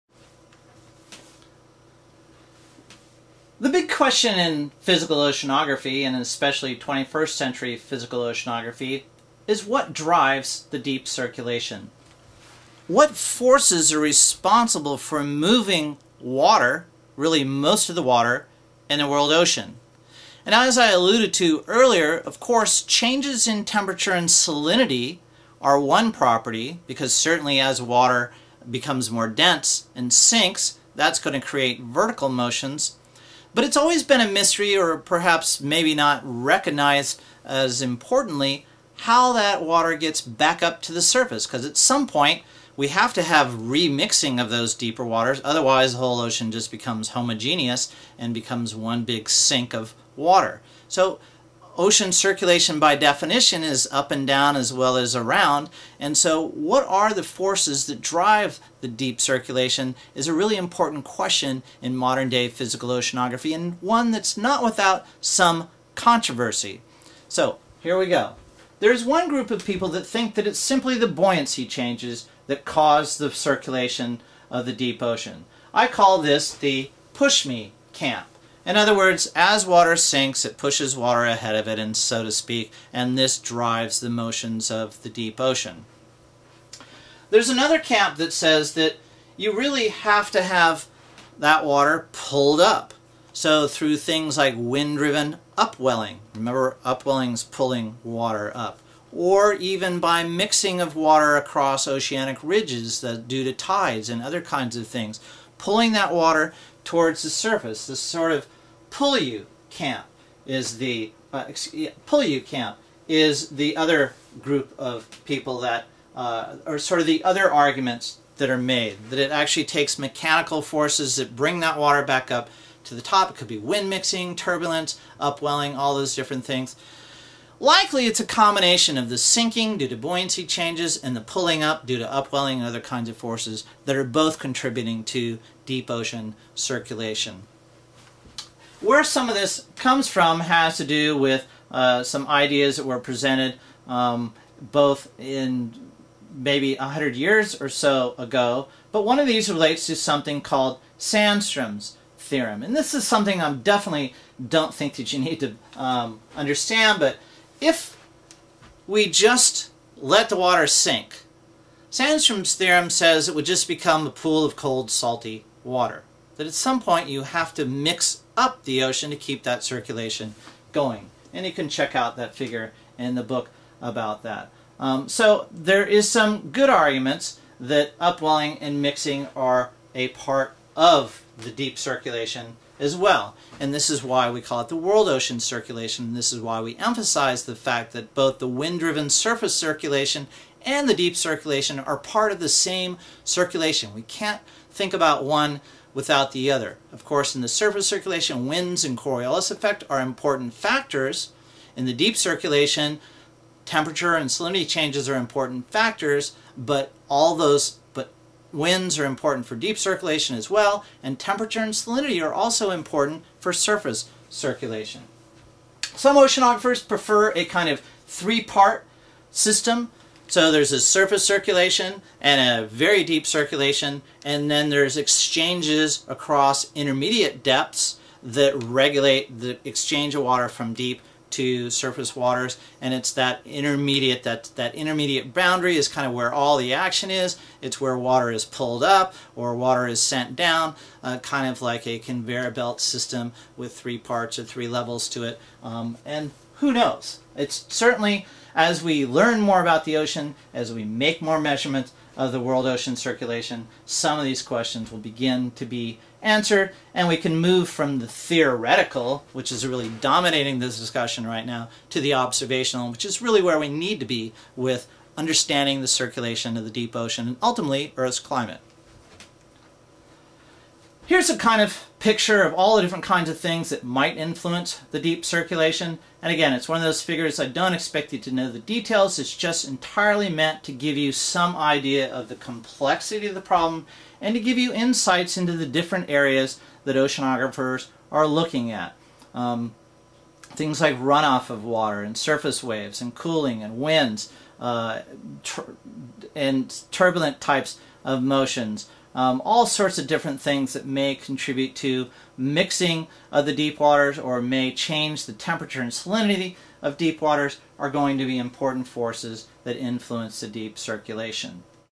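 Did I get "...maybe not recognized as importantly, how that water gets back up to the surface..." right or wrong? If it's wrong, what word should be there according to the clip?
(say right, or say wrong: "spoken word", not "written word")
right.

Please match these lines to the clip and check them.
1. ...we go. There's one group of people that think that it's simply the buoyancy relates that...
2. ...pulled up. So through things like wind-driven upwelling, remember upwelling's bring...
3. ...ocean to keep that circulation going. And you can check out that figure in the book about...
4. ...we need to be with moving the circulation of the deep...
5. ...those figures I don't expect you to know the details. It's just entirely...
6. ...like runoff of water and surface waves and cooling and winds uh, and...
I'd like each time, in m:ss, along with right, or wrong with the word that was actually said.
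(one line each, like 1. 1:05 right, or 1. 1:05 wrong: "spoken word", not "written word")
1. 1:07 wrong: "changes", not "relates"
2. 1:32 wrong: "pulling", not "bring"
3. 2:48 right
4. 4:23 wrong: "understanding", not "moving"
5. 4:36 right
6. 4:50 right.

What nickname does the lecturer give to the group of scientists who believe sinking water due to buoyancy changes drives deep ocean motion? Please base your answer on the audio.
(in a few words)
push me camp.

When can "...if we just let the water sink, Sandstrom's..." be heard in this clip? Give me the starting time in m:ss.
2:37.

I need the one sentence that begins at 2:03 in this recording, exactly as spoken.
It could be wind mixing, turbulence, upwelling, all those different things.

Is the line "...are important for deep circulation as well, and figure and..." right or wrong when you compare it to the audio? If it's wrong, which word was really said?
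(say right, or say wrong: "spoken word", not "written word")
wrong: "temperature", not "figure".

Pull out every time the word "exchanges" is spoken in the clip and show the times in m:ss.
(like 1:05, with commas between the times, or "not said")
3:44, 3:49.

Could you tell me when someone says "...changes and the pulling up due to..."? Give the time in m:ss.
2:10.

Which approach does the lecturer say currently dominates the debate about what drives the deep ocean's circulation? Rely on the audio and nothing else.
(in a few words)
the theoretical.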